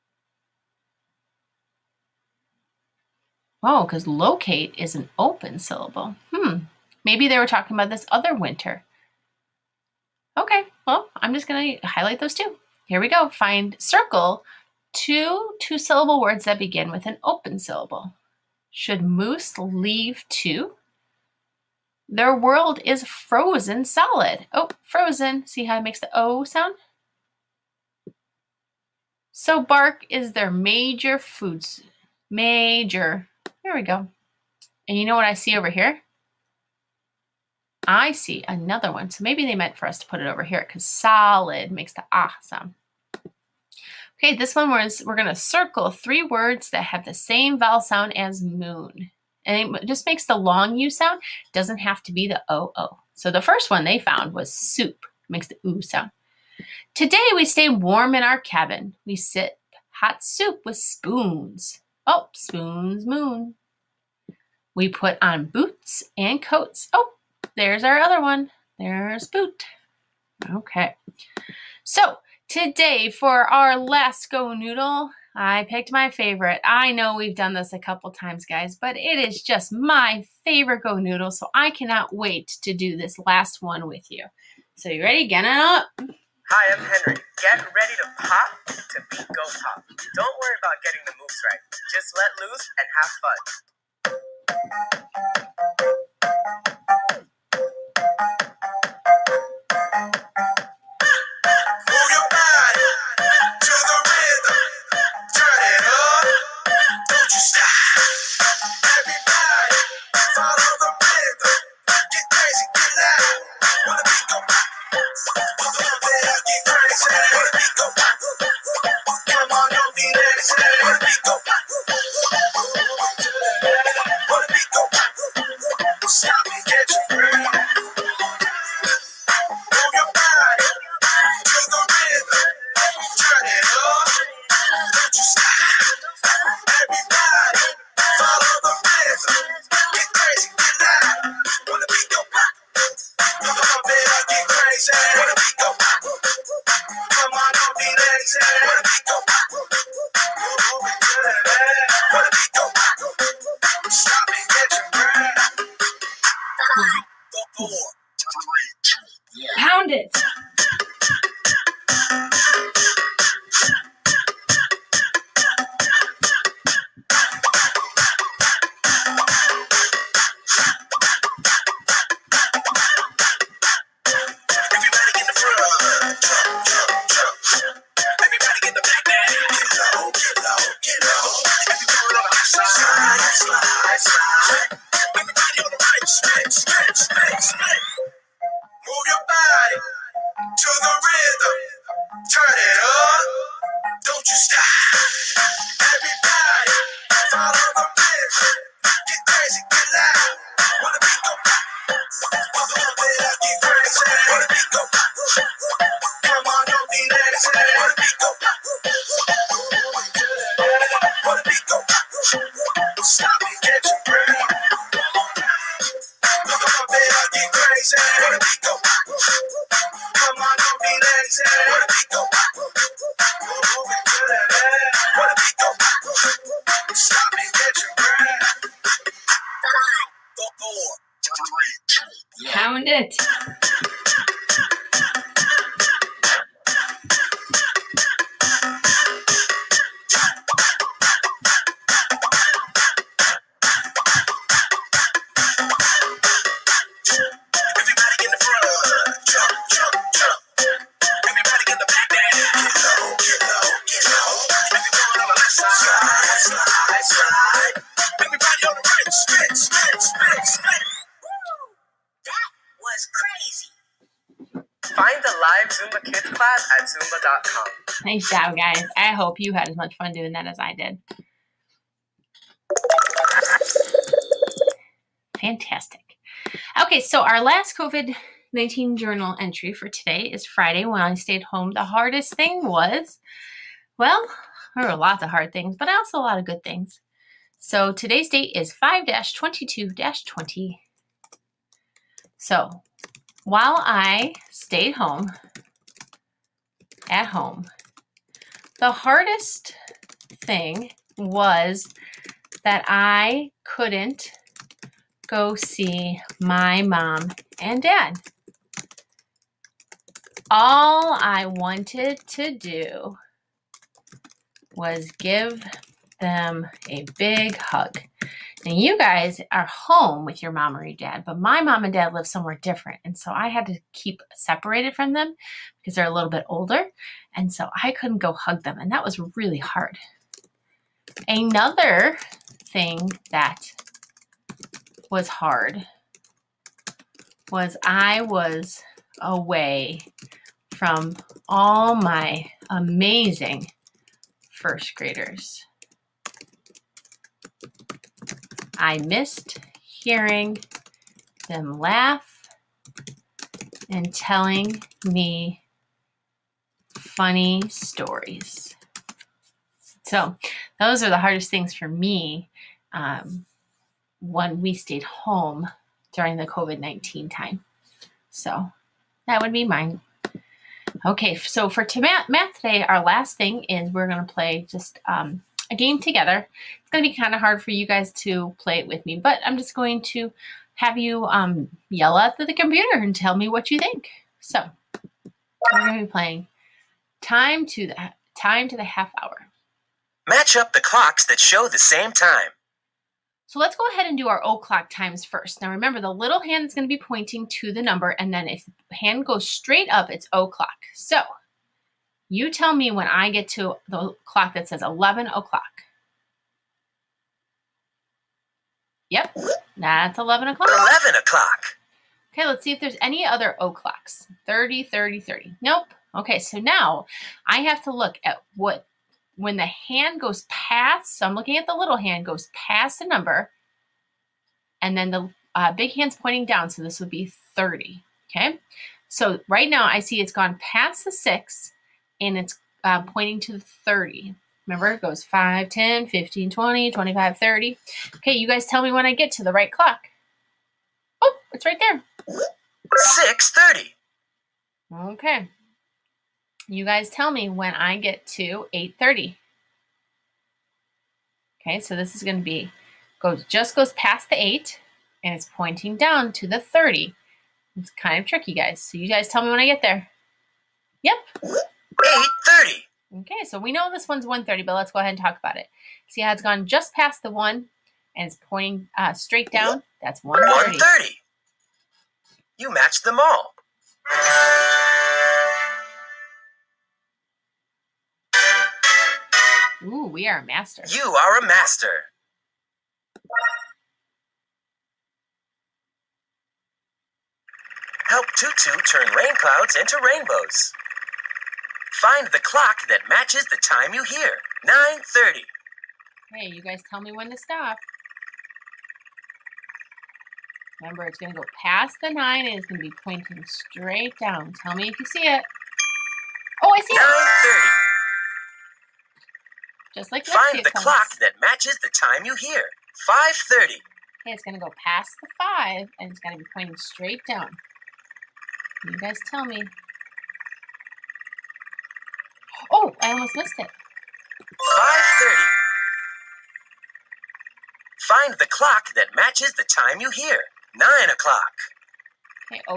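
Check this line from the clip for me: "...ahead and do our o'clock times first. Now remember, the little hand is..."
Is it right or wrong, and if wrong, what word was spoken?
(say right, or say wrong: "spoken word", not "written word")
right.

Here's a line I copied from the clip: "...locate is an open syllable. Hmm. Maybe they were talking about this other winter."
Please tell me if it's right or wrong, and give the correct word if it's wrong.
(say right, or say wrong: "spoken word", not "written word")
right.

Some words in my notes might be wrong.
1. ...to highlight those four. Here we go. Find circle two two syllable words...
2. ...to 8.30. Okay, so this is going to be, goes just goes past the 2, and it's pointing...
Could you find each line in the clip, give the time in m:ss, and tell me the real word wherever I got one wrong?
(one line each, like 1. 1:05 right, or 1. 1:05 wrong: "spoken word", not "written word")
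1. 0:11 wrong: "two", not "four"
2. 7:28 wrong: "8", not "2".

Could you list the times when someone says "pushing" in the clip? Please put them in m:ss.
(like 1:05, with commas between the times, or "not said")
not said.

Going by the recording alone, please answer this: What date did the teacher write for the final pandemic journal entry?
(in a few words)
5/22/20.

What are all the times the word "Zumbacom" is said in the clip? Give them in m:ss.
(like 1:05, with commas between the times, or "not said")
4:26.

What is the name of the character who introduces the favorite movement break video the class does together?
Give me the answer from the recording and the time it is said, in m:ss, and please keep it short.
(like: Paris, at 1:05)
Henry, at 1:26.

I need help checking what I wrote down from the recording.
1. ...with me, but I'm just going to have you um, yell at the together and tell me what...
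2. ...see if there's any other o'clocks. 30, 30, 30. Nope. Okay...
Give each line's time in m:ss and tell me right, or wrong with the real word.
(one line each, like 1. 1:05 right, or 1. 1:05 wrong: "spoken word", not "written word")
1. 6:18 wrong: "computer", not "together"
2. 6:52 right.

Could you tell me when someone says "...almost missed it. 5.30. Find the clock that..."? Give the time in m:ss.
8:43.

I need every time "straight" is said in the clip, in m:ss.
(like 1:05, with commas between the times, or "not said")
6:39, 7:49, 8:23, 8:36.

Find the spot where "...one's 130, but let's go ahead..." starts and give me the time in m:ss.
7:44.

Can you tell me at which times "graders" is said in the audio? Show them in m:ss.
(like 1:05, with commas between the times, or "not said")
5:44.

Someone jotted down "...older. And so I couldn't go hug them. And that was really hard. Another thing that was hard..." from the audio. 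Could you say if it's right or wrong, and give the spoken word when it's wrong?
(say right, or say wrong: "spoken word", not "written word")
right.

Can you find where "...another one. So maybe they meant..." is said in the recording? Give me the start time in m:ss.
0:38.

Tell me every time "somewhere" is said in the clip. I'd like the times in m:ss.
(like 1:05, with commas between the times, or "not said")
5:22.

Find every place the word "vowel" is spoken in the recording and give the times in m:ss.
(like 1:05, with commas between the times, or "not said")
0:47.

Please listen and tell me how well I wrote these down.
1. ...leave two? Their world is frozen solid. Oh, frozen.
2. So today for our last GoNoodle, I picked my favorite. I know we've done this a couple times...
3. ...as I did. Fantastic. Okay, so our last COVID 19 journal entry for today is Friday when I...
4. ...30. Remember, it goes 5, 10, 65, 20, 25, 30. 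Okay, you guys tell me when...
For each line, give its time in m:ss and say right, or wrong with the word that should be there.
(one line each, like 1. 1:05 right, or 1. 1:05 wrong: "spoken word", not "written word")
1. 0:19 right
2. 1:11 right
3. 4:30 right
4. 7:13 wrong: "15", not "65".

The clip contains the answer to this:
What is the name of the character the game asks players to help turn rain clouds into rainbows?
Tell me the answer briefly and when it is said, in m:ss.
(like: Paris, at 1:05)
Tutu, at 8:08.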